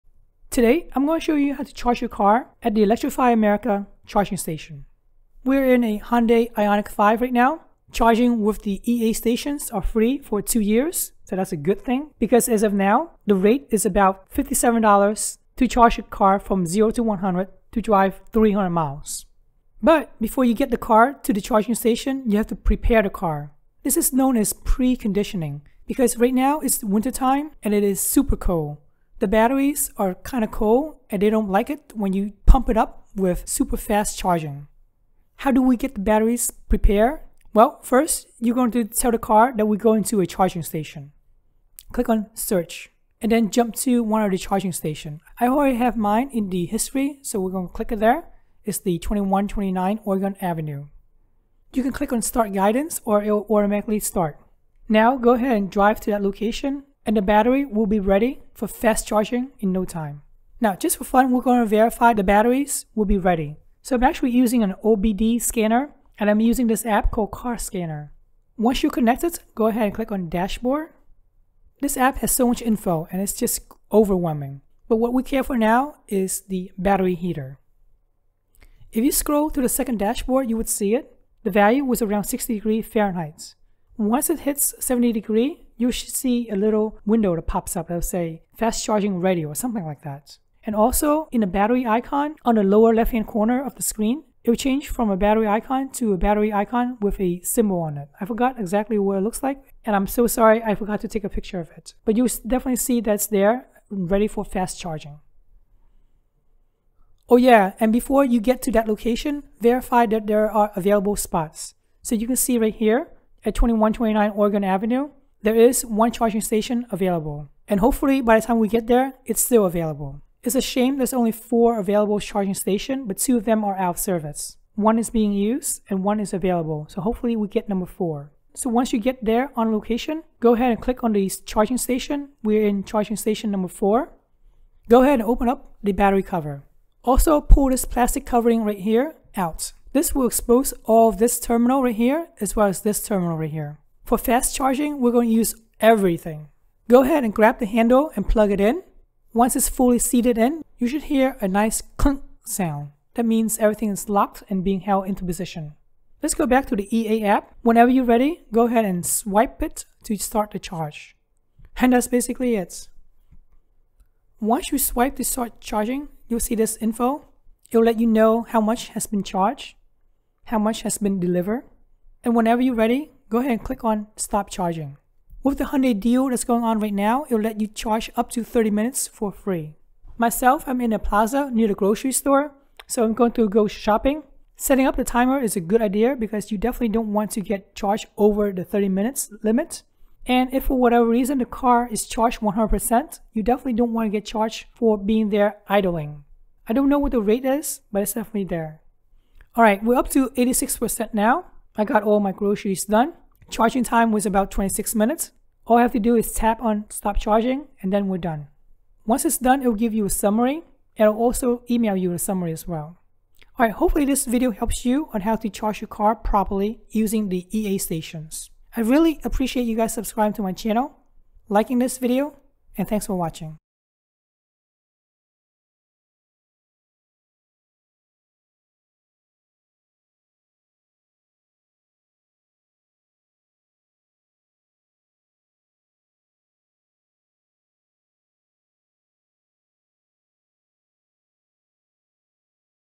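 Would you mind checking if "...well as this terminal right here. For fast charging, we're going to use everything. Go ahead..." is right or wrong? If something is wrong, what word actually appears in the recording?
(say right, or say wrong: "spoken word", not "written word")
right.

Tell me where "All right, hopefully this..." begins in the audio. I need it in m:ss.
3:33.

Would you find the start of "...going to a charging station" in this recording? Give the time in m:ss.
0:39.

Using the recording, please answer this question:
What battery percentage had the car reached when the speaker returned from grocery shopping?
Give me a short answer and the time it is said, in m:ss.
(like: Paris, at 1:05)
86%, at 3:20.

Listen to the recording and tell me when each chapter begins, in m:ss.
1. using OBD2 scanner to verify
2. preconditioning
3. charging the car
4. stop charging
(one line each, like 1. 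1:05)
1. 1:00
2. 0:35
3. 2:08
4. 3:19.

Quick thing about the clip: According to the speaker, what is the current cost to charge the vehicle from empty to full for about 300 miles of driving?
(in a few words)
$57.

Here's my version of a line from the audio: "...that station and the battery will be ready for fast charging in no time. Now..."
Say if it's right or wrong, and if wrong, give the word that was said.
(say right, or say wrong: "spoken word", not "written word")
wrong: "location", not "station".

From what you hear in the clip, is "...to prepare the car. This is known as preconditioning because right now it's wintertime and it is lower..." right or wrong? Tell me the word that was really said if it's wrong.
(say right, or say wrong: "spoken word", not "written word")
wrong: "super", not "lower".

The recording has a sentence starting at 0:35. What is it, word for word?
How do we get the batteries prepared?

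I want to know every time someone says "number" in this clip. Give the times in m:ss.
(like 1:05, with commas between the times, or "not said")
2:07, 2:13.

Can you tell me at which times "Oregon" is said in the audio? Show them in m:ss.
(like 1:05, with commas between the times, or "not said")
0:50, 1:54.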